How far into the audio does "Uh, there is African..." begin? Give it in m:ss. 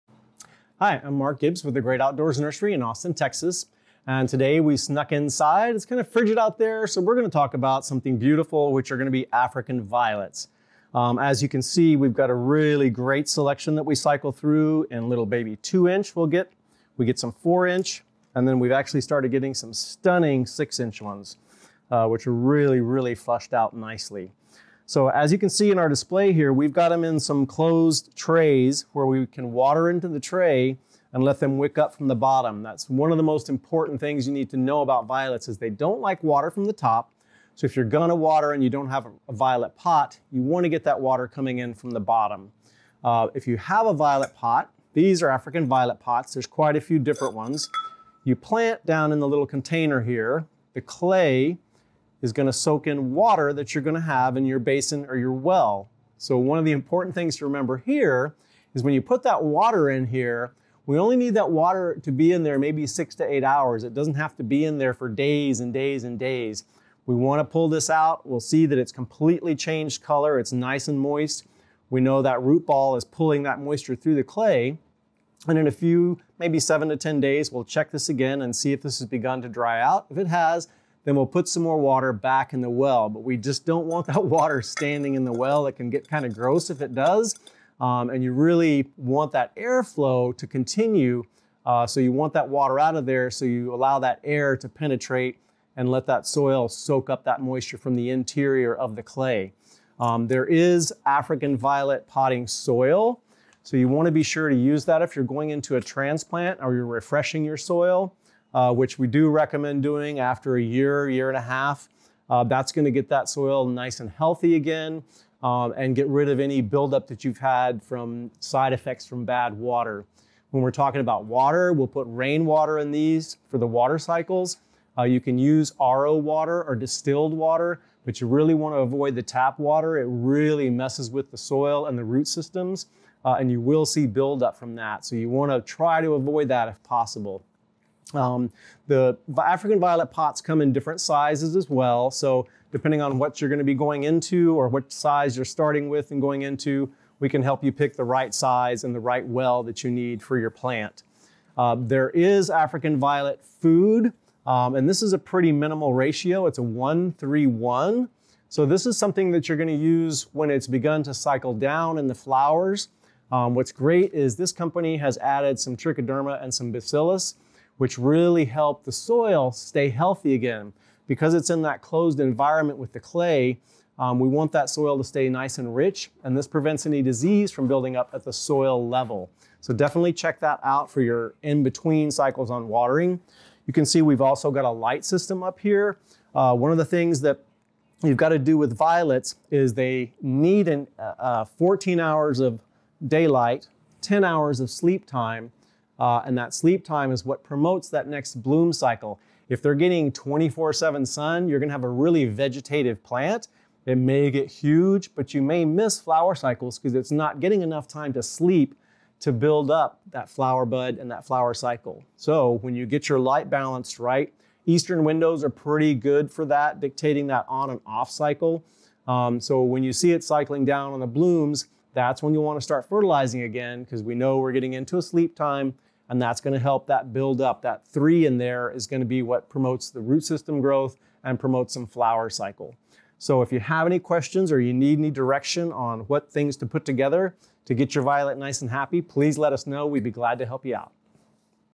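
2:31.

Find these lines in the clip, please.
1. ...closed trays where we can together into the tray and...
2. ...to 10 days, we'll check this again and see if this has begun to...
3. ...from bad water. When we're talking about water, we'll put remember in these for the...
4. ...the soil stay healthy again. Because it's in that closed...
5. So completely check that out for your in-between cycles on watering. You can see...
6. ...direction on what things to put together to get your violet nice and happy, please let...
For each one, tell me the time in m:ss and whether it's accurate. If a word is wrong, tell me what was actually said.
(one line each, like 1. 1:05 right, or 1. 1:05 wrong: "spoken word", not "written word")
1. 0:27 wrong: "water", not "together"
2. 1:16 right
3. 1:59 wrong: "rainwater", not "remember"
4. 2:48 right
5. 2:59 wrong: "definitely", not "completely"
6. 3:55 right.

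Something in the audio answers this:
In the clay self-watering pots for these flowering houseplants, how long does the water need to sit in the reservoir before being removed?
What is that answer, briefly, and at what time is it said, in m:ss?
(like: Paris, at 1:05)
6 to 8 hours, at 1:02.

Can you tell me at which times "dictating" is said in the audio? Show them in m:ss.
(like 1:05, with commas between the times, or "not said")
3:36.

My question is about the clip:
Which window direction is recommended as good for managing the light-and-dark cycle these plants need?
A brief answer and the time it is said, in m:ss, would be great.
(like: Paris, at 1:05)
Eastern, at 3:34.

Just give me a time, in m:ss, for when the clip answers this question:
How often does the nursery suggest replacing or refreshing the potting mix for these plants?
1:50.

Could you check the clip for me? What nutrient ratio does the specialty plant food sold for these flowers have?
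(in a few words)
1-3-1.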